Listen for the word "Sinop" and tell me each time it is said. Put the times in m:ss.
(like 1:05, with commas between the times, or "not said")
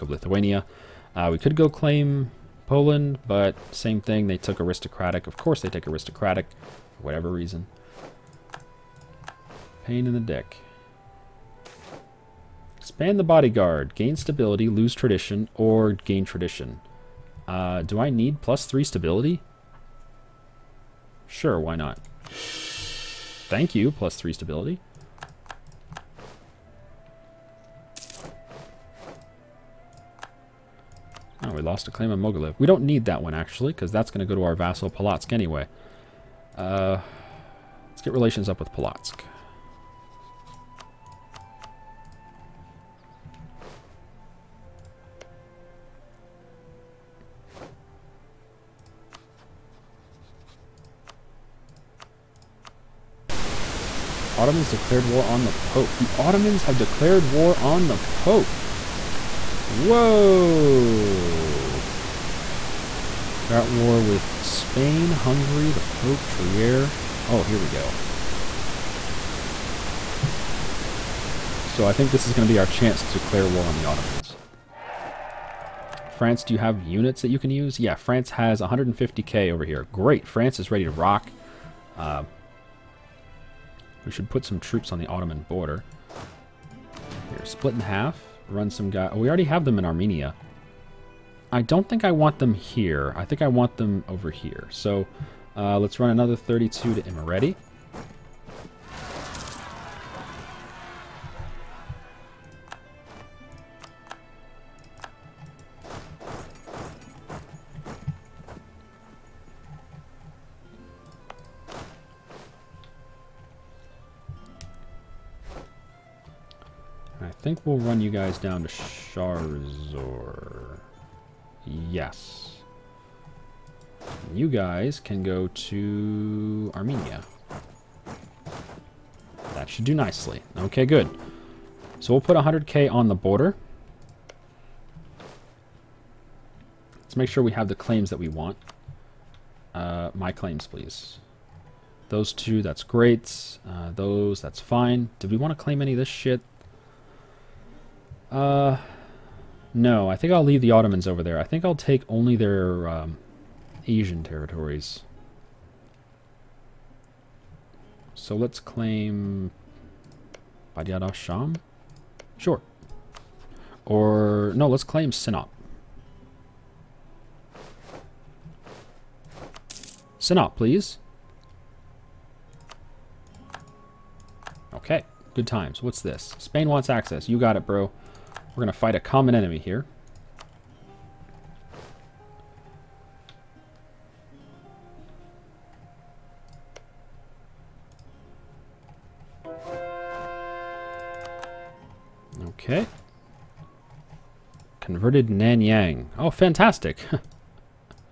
2:45, 2:50.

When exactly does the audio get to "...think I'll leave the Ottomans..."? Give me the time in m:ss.
2:30.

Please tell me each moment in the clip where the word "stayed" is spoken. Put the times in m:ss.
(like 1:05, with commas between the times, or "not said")
not said.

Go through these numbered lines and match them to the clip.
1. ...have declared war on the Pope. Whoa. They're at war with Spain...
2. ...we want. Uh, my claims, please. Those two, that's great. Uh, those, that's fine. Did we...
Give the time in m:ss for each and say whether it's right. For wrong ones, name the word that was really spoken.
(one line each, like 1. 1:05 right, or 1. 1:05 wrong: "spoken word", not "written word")
1. 0:56 right
2. 2:18 right.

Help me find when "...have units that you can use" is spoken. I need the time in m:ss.
1:16.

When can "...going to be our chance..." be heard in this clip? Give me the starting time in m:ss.
1:12.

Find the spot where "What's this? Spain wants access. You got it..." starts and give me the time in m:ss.
2:55.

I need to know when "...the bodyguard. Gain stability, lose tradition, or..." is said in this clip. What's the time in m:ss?
0:13.